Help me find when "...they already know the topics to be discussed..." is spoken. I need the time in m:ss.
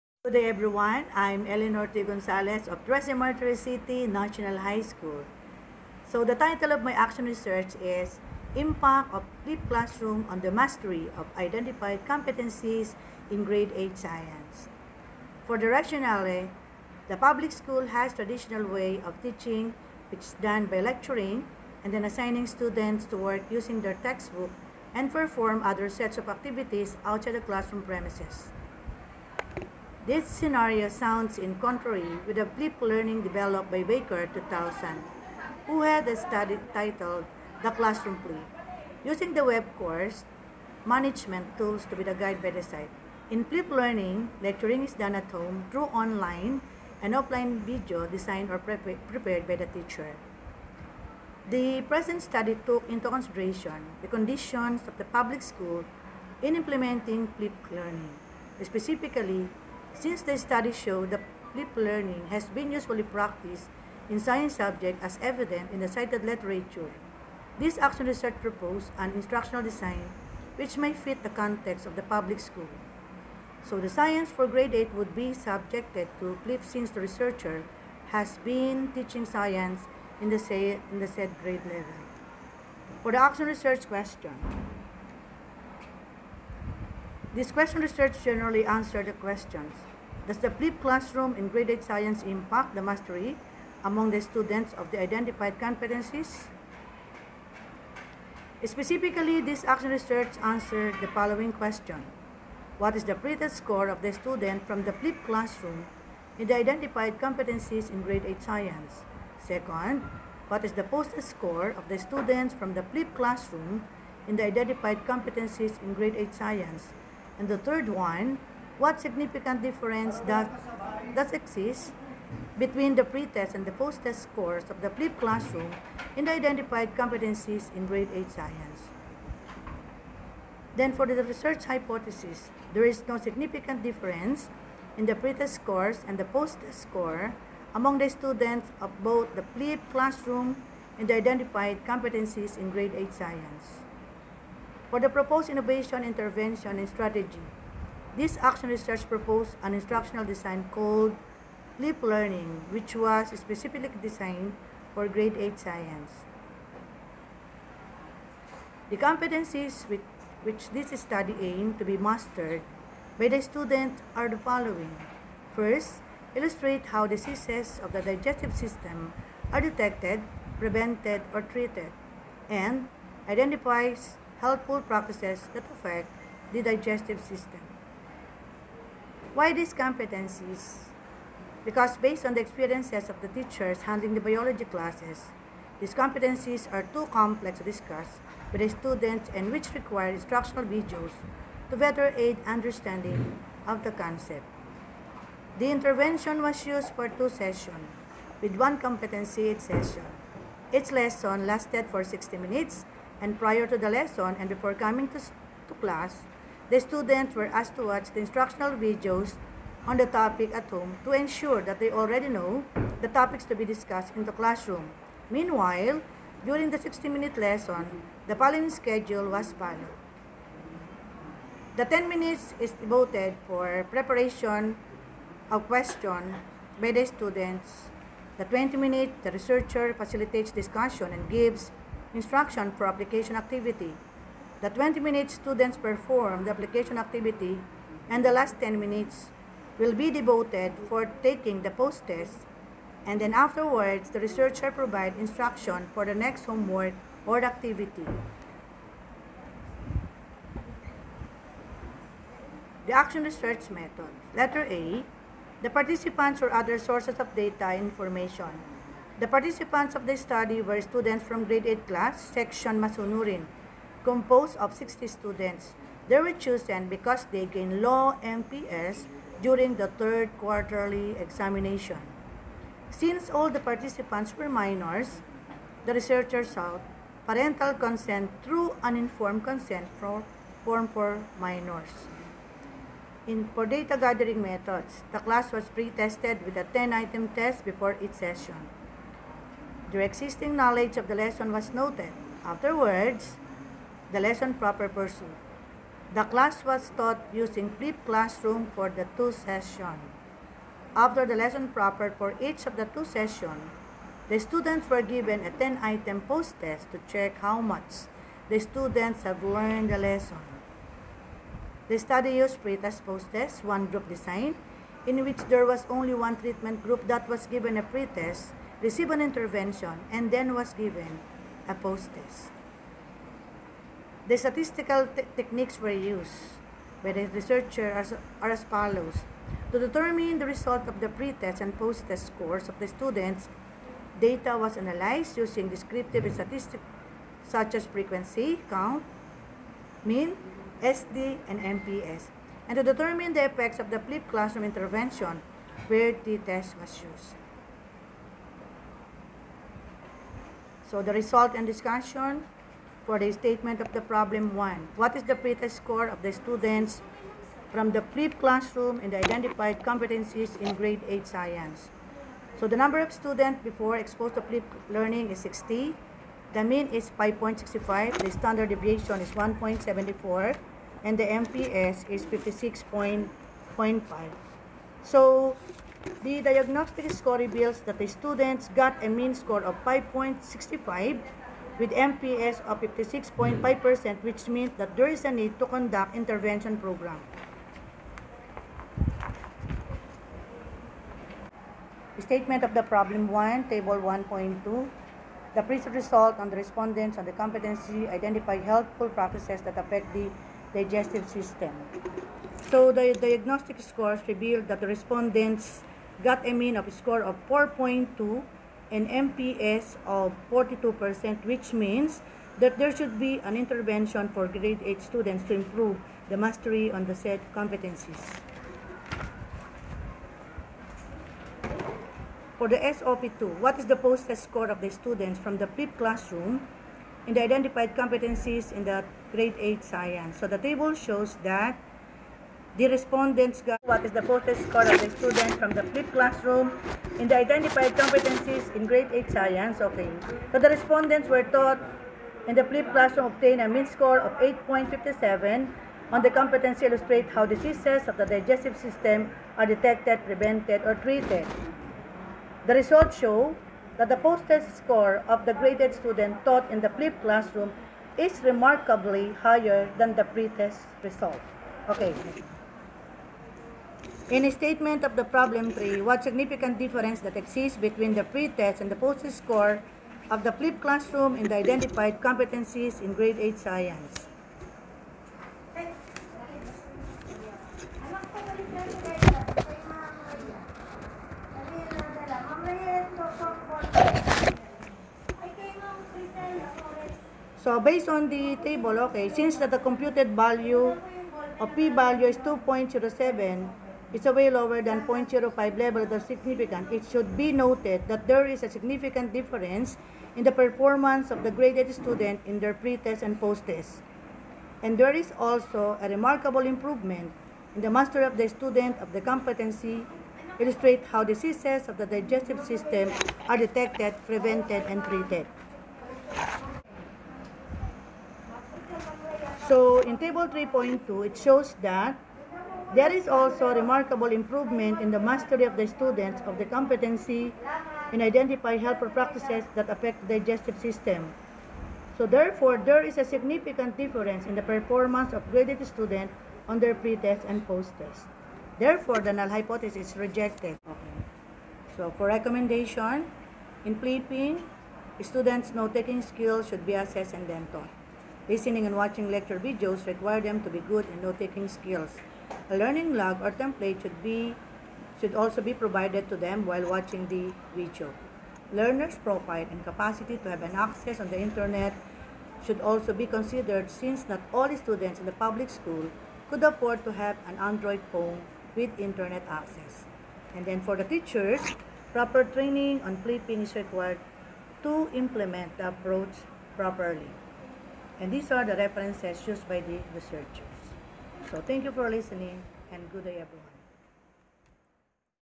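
3:31.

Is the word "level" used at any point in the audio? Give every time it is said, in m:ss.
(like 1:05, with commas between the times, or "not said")
1:21, 8:15.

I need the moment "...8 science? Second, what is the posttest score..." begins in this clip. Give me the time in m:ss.
1:48.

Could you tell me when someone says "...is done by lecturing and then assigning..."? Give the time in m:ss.
0:20.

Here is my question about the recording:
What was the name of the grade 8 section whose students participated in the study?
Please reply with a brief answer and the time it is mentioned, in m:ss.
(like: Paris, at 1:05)
Masunurin, at 4:22.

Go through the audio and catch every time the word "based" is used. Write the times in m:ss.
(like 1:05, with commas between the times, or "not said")
3:01, 8:07.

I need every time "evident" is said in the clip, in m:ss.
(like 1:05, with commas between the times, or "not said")
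1:05.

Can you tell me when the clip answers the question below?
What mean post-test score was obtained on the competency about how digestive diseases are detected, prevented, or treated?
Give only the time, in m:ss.
7:24.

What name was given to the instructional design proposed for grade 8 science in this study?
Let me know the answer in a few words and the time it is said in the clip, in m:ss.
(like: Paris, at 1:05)
Leap Learning, at 2:31.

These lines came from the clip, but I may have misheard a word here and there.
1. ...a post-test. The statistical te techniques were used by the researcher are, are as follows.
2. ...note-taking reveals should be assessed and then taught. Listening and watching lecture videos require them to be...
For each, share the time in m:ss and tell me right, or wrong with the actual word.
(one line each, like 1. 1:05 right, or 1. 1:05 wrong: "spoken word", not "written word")
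1. 5:21 right
2. 9:05 wrong: "skills", not "reveals".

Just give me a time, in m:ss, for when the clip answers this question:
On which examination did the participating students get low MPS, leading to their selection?
4:30.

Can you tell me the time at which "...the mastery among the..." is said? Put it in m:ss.
1:32.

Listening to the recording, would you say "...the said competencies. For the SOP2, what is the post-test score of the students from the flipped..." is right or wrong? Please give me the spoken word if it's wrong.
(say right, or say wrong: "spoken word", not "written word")
right.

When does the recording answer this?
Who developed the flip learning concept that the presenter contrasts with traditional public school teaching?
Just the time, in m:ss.
0:33.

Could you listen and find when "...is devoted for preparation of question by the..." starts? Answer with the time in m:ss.
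3:42.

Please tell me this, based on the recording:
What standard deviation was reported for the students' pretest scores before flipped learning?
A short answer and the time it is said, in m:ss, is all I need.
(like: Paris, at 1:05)
1.74, at 6:09.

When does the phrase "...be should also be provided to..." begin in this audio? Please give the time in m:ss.
9:14.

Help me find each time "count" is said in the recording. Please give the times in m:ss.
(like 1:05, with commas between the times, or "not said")
5:38.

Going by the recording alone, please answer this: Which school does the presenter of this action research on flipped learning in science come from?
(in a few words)
Trece Martires City National High School.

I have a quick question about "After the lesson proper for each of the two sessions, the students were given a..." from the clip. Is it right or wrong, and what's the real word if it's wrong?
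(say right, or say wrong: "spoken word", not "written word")
right.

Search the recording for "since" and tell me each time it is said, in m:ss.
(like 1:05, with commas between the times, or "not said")
0:59, 1:16, 4:32, 8:09, 9:23.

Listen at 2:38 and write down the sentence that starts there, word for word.
The competencies with which this study aimed to be mastered by the student are the following.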